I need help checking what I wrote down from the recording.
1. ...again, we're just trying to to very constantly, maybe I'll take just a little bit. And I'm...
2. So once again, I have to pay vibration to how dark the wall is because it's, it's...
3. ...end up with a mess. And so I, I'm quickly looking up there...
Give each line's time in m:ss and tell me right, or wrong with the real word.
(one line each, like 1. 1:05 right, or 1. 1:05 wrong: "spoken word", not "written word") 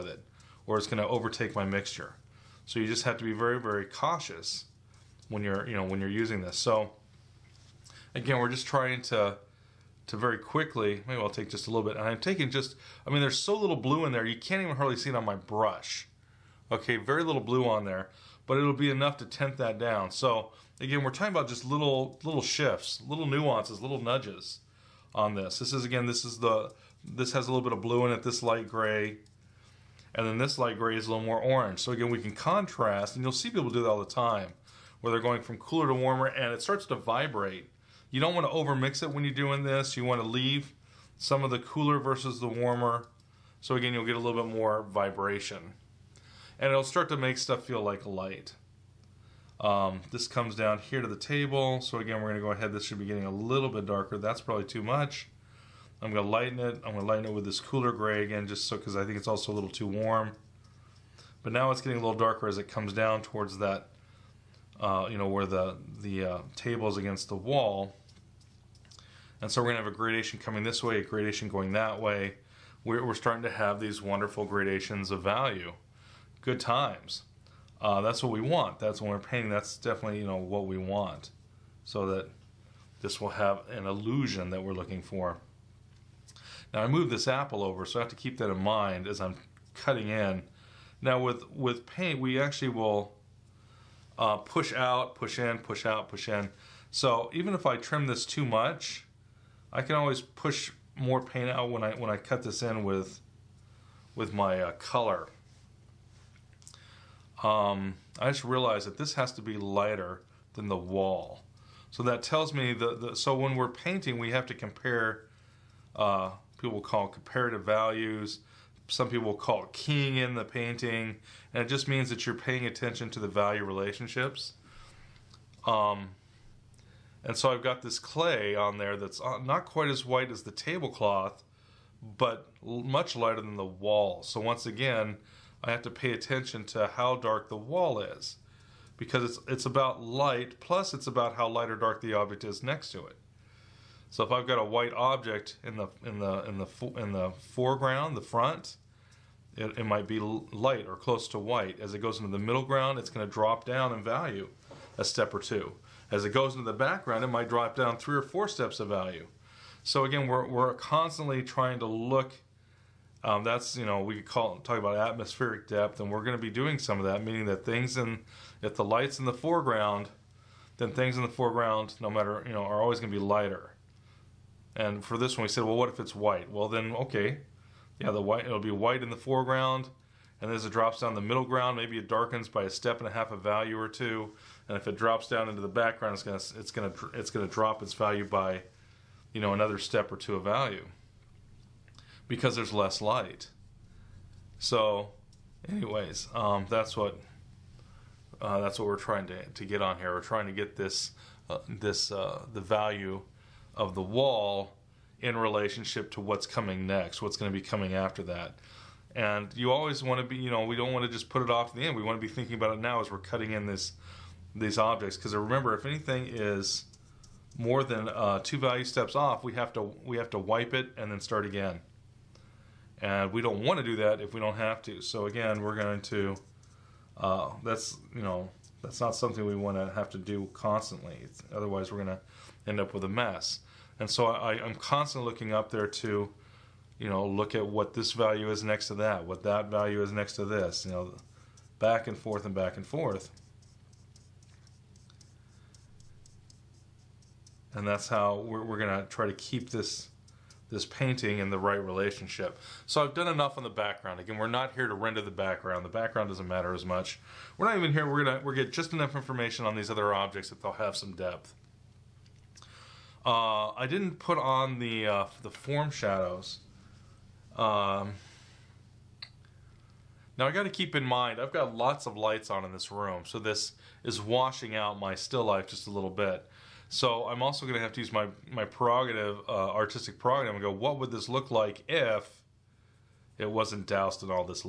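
1. 0:08 wrong: "quickly", not "constantly"
2. 2:14 wrong: "attention", not "vibration"
3. 3:52 wrong: "constantly", not "quickly".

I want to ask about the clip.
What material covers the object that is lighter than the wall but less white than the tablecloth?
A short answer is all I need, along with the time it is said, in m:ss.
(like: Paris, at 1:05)
clay, at 2:07.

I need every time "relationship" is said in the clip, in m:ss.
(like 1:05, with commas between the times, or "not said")
2:03, 3:25, 4:11.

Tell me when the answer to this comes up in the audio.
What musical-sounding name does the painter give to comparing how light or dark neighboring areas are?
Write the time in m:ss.
1:59.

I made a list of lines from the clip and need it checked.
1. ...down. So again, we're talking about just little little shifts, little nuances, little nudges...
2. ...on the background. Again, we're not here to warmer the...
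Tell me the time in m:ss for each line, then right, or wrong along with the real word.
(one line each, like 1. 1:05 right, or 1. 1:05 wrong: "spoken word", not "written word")
1. 0:19 right
2. 4:13 wrong: "render", not "warmer".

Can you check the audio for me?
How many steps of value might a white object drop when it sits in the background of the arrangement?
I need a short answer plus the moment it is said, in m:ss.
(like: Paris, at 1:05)
3 or 4, at 2:37.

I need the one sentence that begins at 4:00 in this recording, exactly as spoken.
You know, back and forth and back and forth.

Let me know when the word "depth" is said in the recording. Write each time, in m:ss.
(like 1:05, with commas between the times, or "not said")
2:45, 4:21.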